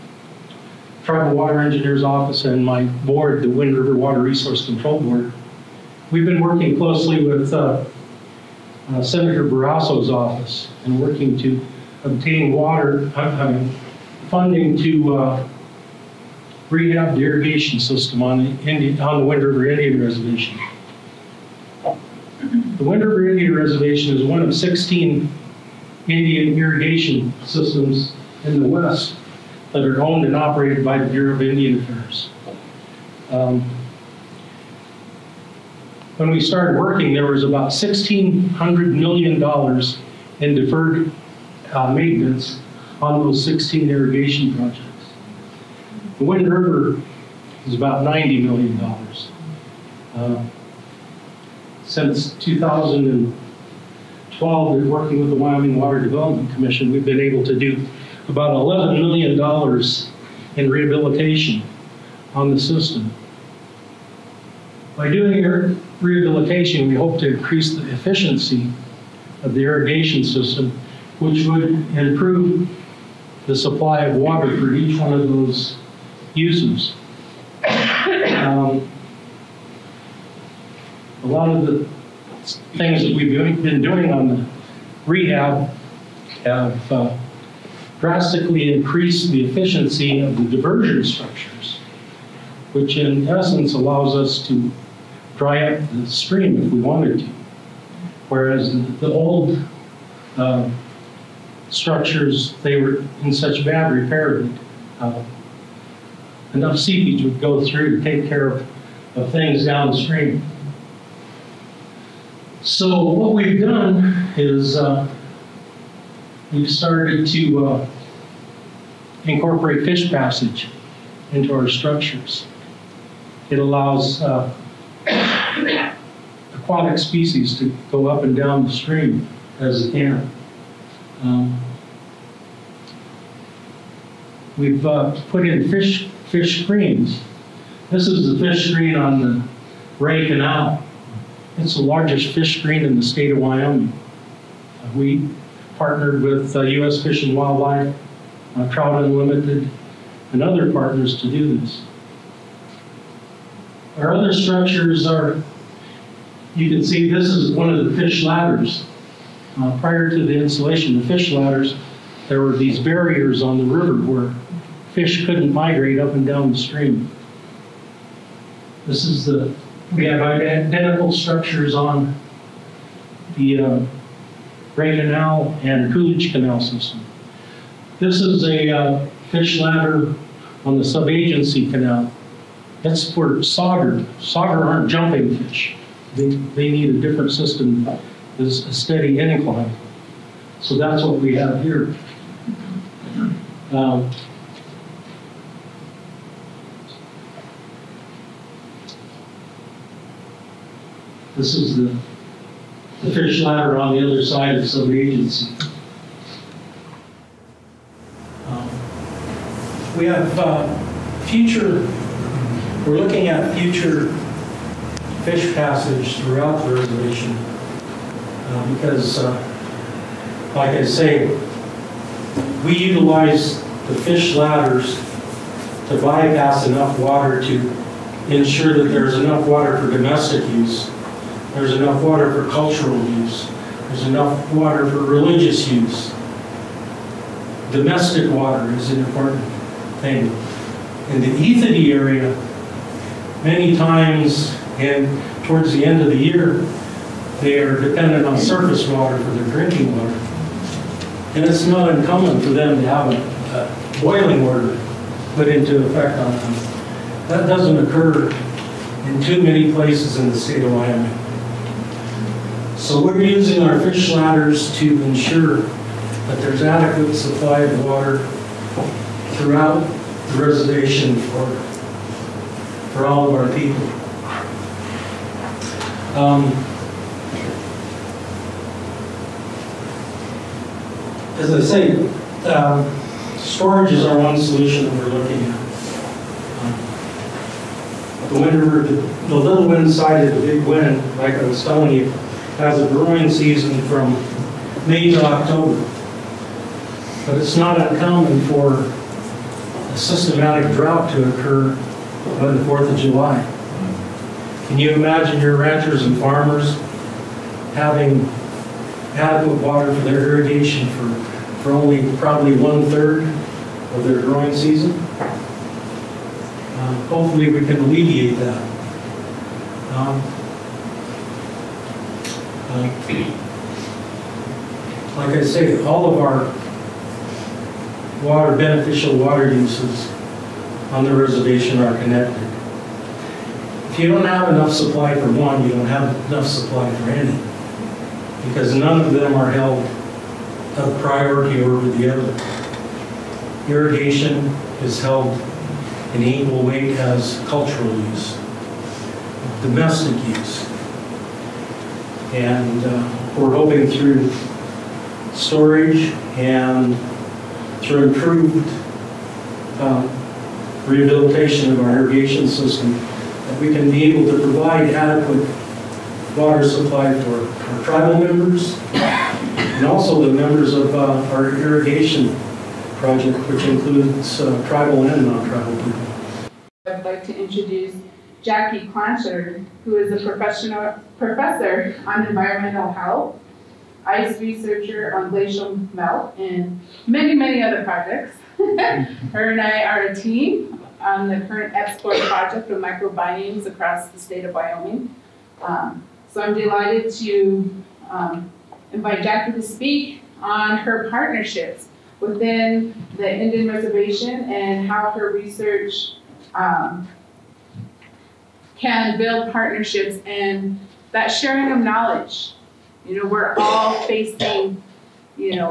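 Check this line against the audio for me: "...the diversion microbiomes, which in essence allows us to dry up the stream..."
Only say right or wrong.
wrong.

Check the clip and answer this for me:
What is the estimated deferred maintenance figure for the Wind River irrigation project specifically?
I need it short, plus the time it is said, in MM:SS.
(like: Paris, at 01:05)
$90 million, at 00:48.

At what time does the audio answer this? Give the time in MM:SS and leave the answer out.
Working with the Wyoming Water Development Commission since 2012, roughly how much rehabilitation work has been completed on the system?
00:58.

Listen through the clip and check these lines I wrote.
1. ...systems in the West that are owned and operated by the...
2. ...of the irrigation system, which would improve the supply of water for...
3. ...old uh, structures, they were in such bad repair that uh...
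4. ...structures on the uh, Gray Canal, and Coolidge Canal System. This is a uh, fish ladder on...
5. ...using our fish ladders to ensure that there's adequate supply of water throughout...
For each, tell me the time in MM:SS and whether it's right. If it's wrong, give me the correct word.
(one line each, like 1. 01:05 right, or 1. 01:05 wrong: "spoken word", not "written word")
1. 00:27 right
2. 01:09 right
3. 01:39 right
4. 02:51 right
5. 04:23 right.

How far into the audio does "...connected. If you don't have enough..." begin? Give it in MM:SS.
05:32.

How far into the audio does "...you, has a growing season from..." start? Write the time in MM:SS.
04:51.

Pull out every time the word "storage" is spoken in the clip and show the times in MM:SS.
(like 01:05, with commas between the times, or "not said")
04:43, 05:55.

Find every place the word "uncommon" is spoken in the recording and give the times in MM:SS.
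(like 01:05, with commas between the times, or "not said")
04:11, 04:57.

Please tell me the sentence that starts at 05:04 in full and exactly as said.
Can you imagine your ranchers and farmers having adequate water for their irrigation for, for only probably one-third of their growing season?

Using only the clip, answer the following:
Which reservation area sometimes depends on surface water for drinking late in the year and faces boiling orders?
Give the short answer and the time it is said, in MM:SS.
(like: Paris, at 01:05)
Ethete, at 04:01.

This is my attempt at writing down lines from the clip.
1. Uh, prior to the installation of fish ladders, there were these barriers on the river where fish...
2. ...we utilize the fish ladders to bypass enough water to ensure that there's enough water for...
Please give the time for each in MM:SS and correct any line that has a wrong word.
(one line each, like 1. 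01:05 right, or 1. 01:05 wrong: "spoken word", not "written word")
1. 02:39 right
2. 03:42 right.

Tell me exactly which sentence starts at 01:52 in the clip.
So what we've done is uh, we've started to uh, incorporate fish passage into our structures.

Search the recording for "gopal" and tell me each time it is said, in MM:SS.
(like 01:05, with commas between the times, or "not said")
not said.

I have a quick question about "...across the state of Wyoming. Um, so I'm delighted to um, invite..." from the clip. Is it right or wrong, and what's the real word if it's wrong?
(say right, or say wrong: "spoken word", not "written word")
right.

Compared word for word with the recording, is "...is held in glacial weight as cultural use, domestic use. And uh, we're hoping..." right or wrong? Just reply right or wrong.
wrong.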